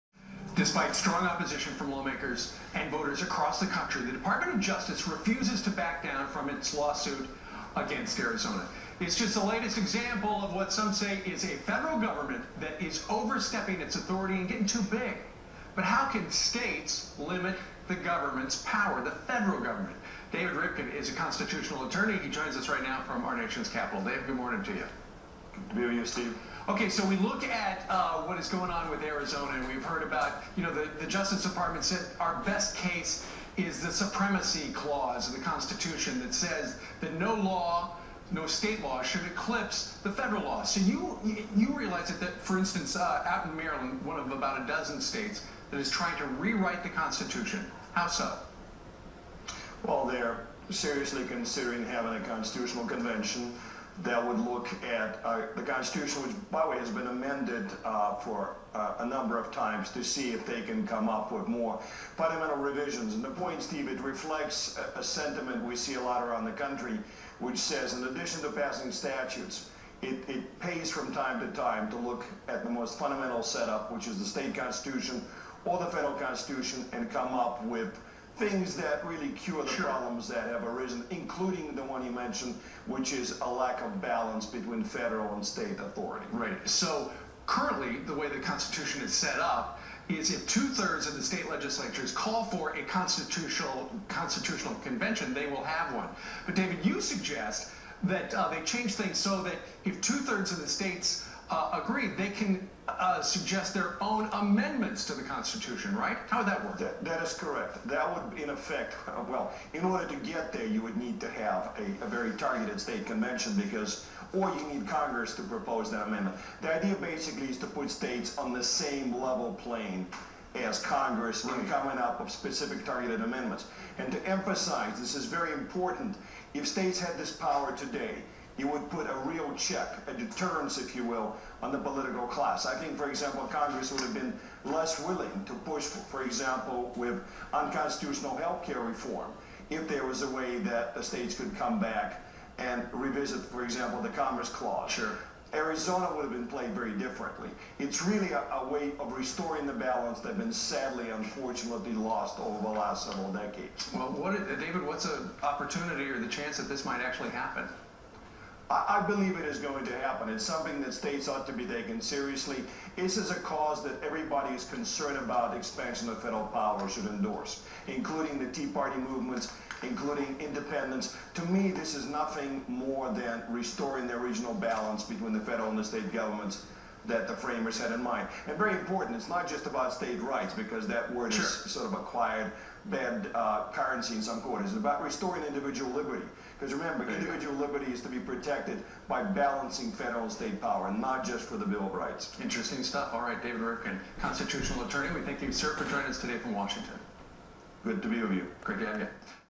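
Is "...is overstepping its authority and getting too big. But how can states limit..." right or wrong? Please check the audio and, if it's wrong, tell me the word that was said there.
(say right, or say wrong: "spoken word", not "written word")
right.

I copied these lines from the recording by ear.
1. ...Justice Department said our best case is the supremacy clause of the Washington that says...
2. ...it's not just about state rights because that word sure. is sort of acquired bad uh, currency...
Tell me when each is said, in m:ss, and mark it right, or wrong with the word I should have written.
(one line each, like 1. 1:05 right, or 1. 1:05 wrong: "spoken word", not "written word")
1. 0:31 wrong: "Constitution", not "Washington"
2. 2:59 right.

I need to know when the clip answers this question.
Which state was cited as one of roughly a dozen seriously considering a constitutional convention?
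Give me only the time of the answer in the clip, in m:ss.
0:43.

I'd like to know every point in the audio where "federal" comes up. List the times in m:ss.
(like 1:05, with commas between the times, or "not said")
0:11, 0:19, 0:40, 1:15, 1:24, 2:46, 2:55, 3:09.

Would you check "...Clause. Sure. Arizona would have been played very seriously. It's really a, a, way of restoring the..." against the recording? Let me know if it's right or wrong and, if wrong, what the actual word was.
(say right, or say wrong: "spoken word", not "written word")
wrong: "differently", not "seriously".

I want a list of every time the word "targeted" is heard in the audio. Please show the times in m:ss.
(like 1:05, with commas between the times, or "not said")
1:52, 2:02.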